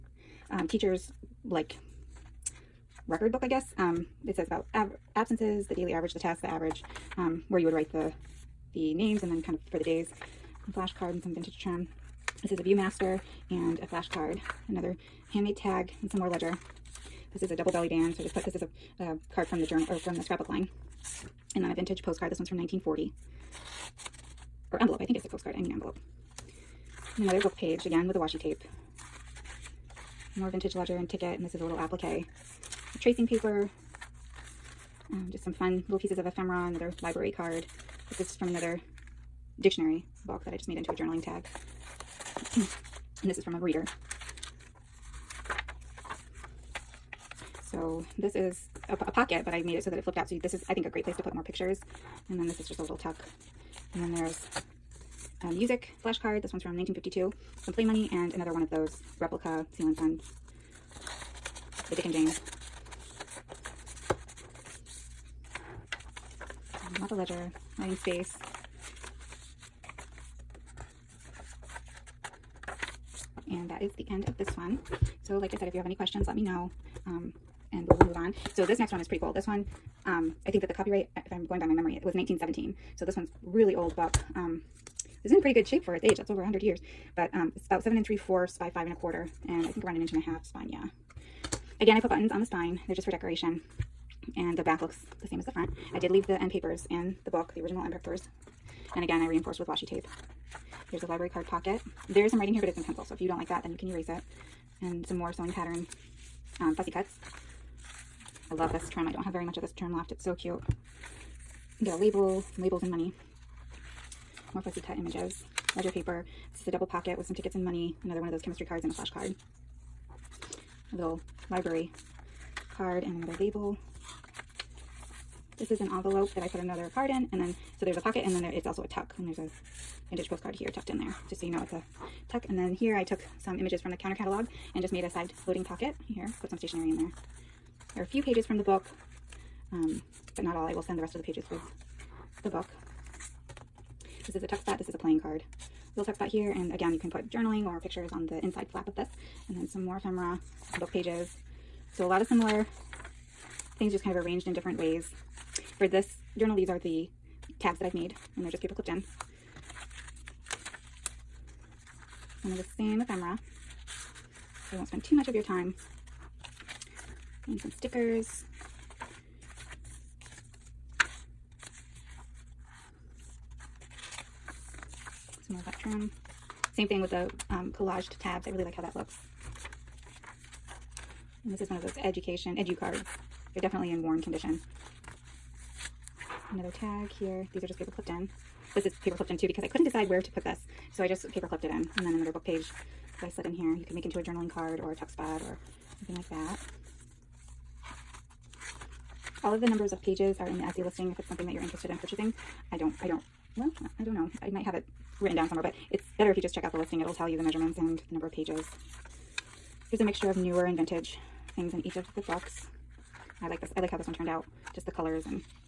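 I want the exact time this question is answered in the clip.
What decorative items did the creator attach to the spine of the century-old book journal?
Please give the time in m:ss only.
1:32.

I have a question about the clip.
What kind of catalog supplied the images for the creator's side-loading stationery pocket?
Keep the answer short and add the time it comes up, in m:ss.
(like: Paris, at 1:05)
Counter catalog, at 2:13.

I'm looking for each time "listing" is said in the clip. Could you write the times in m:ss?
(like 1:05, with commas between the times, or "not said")
3:20, 3:26.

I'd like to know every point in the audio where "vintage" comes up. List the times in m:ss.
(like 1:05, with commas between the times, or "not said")
0:11, 0:21, 0:30, 2:10, 3:30.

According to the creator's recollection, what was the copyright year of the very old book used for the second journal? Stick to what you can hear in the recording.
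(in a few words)
1917.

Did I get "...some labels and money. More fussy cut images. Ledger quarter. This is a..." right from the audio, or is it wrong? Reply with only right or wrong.
wrong.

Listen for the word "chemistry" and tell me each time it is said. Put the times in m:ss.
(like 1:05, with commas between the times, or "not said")
1:58.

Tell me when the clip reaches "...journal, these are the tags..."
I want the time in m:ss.
2:36.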